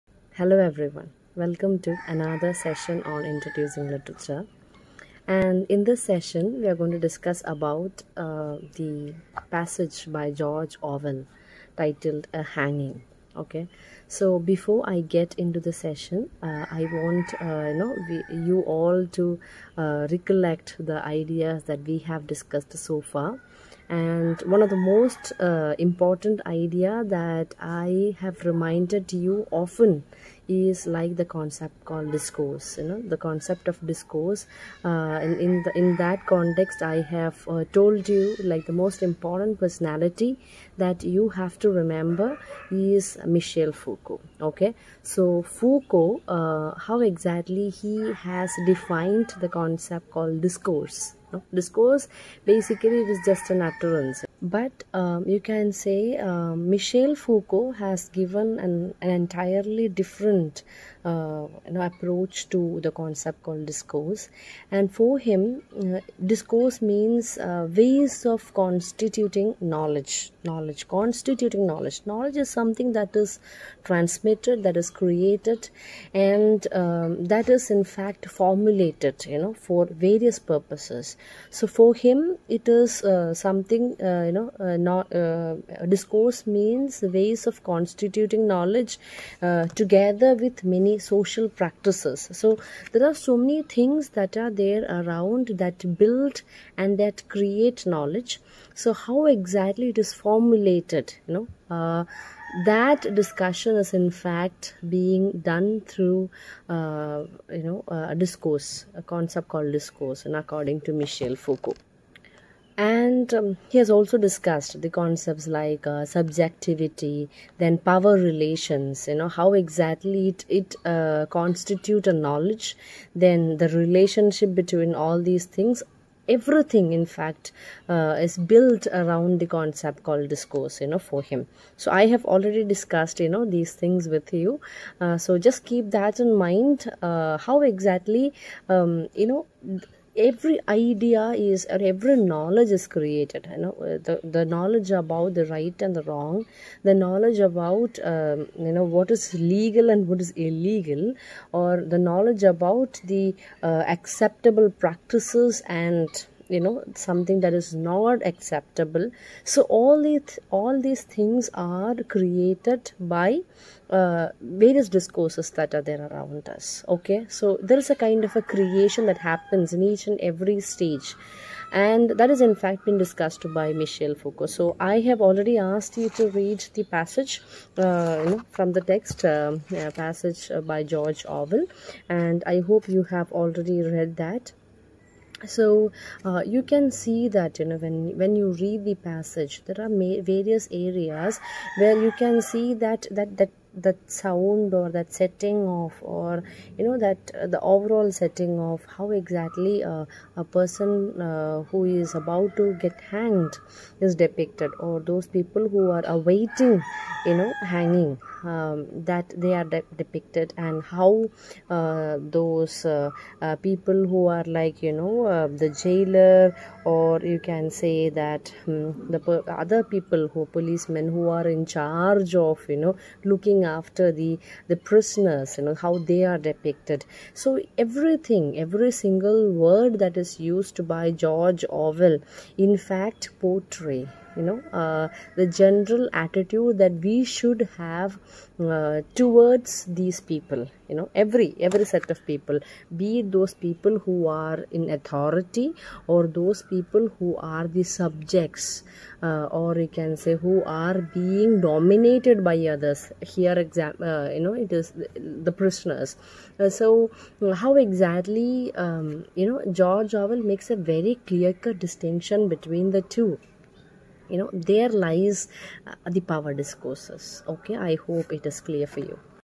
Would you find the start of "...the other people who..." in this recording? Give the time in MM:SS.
03:39.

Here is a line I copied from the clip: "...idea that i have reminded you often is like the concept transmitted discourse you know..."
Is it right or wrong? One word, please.
wrong.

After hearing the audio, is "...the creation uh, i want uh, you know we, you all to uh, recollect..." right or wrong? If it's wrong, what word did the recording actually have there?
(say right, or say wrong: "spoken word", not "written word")
wrong: "session", not "creation".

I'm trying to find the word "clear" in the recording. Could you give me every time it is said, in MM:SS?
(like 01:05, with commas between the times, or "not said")
04:21, 04:28.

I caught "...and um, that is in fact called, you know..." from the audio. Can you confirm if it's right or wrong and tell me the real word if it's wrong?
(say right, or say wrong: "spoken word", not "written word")
wrong: "formulated", not "called".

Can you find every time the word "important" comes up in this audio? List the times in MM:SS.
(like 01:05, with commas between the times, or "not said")
00:25, 00:39.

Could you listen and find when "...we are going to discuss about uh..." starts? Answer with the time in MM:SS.
00:06.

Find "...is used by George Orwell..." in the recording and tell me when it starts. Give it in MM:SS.
03:50.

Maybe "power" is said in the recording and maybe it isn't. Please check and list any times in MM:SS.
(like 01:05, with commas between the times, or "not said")
01:57, 04:26.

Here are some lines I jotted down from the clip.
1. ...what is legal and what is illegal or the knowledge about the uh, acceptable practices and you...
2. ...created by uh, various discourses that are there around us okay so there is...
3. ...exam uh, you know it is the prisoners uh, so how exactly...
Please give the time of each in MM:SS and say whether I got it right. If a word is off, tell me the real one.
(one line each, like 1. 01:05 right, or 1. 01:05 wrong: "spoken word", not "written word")
1. 02:28 right
2. 02:42 right
3. 04:13 right.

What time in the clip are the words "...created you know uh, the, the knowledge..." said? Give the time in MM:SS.
02:22.